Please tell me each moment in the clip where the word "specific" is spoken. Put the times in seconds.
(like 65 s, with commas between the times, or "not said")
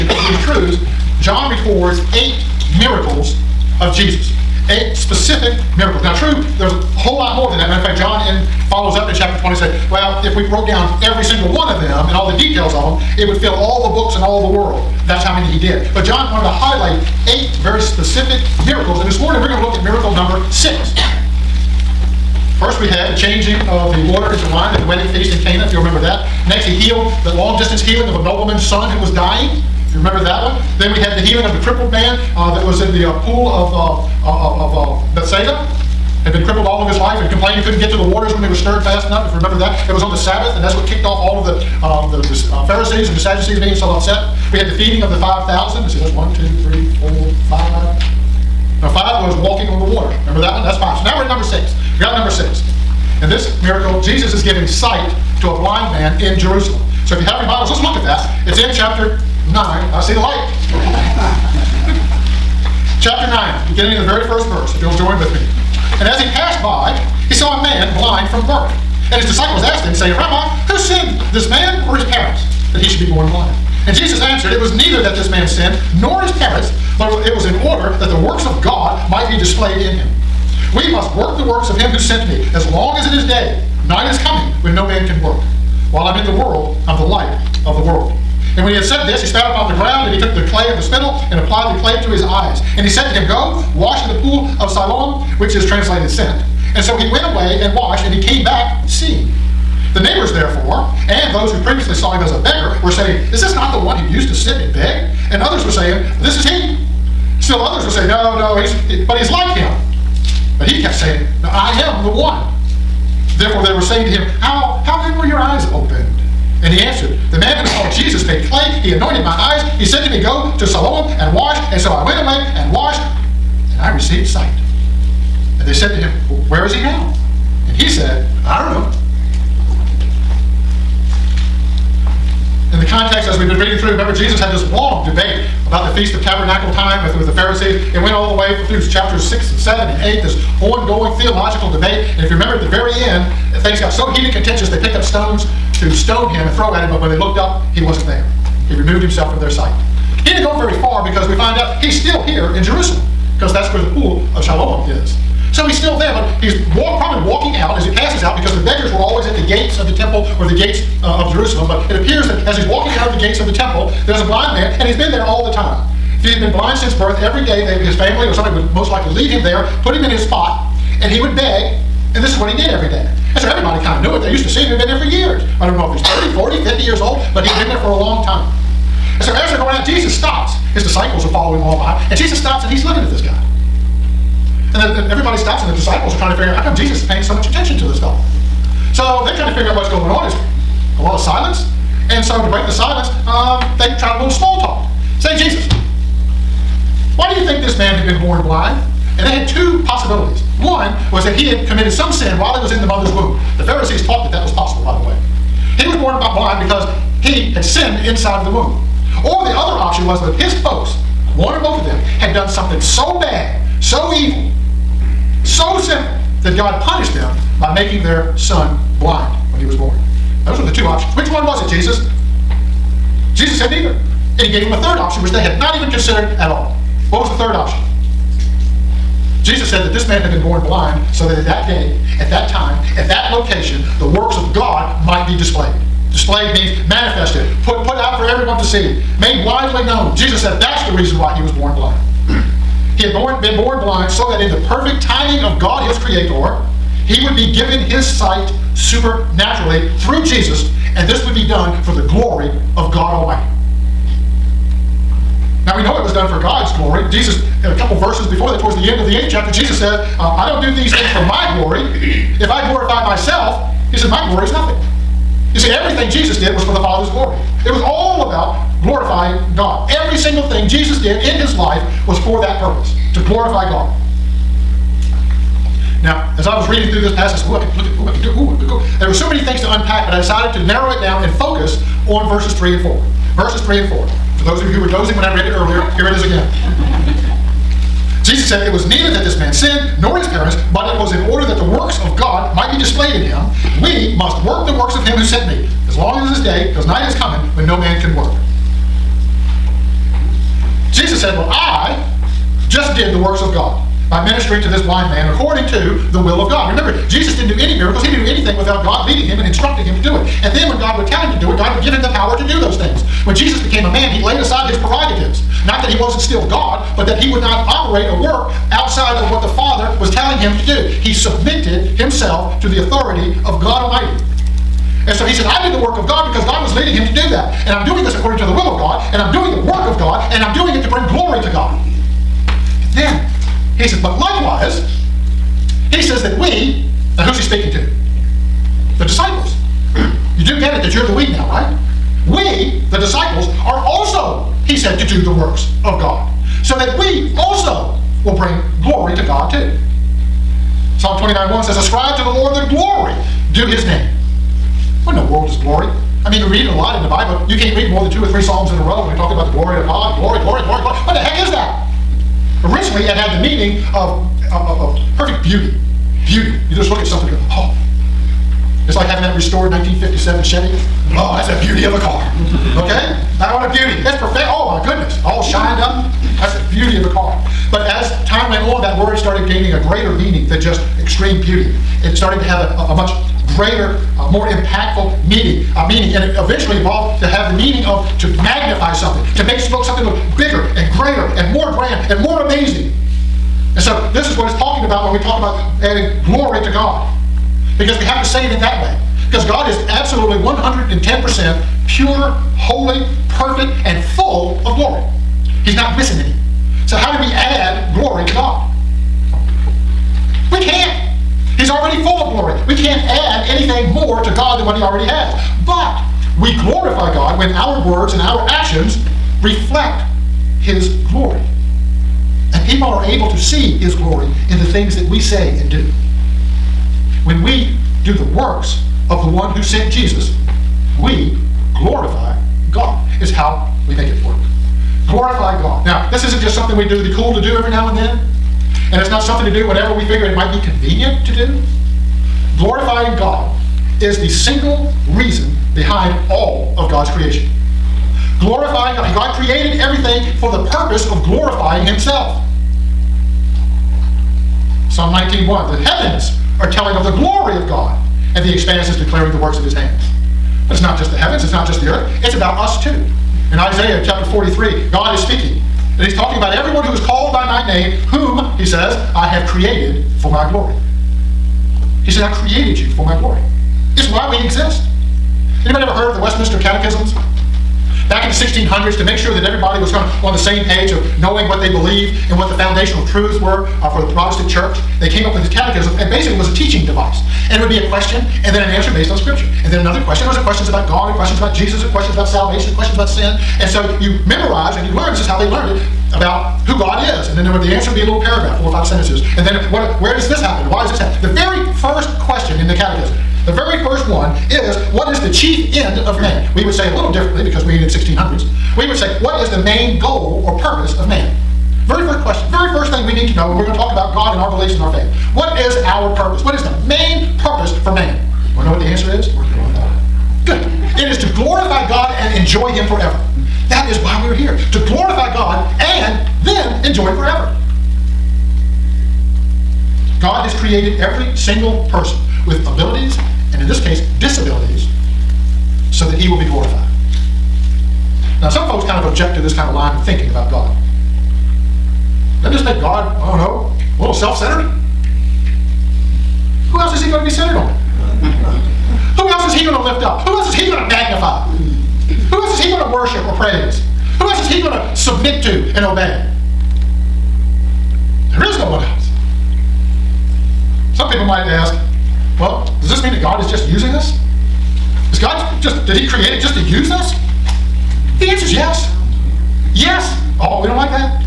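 4 s, 17 s.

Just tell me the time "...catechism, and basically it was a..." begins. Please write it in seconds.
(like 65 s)
485 s.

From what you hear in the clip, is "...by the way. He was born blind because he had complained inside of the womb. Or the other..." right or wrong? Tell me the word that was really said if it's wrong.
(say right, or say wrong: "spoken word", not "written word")
wrong: "sinned", not "complained".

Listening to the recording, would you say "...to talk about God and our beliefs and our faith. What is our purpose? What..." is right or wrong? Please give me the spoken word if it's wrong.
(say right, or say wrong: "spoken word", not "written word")
right.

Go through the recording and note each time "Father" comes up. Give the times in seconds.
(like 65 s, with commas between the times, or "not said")
266 s, 319 s.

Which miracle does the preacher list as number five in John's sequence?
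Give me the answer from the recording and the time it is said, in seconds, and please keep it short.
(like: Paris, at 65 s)
Walking on the water, at 49 s.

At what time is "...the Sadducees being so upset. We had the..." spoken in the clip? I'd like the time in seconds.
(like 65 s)
43 s.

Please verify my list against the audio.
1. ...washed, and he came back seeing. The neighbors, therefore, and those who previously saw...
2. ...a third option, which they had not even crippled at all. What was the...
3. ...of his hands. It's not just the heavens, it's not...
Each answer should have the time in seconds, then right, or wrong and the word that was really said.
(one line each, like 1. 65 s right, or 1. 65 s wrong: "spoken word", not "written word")
1. 97 s right
2. 224 s wrong: "considered", not "crippled"
3. 459 s right.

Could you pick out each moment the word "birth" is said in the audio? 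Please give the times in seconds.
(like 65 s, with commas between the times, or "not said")
68 s, 166 s.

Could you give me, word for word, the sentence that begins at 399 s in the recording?
Because God is absolutely 110% pure, holy, perfect and full of glory.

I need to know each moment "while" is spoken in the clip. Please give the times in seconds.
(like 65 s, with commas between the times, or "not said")
85 s, 202 s.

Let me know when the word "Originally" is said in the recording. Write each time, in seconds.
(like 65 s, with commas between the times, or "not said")
362 s.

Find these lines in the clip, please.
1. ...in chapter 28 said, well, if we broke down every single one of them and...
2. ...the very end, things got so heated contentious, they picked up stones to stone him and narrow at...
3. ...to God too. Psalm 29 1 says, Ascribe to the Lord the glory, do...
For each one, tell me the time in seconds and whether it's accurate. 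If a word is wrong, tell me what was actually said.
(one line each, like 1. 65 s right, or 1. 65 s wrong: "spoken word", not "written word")
1. 9 s wrong: "20", not "28"
2. 142 s wrong: "throw", not "narrow"
3. 349 s right.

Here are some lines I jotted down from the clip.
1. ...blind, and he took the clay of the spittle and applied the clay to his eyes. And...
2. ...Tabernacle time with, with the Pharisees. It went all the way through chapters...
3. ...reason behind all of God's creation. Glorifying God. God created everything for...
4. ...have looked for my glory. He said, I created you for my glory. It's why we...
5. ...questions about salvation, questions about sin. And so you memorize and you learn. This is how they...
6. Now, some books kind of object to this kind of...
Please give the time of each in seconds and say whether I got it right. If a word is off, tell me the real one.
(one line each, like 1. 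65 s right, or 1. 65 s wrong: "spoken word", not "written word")
1. 89 s wrong: "ground", not "blind"
2. 136 s right
3. 445 s right
4. 469 s wrong: "created", not "looked"
5. 491 s right
6. 538 s wrong: "folks", not "books".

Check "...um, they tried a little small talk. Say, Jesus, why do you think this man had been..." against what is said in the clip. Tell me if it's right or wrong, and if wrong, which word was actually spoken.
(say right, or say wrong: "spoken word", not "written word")
right.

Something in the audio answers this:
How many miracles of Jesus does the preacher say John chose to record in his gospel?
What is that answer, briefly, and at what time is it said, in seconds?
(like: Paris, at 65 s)
8, at 2 s.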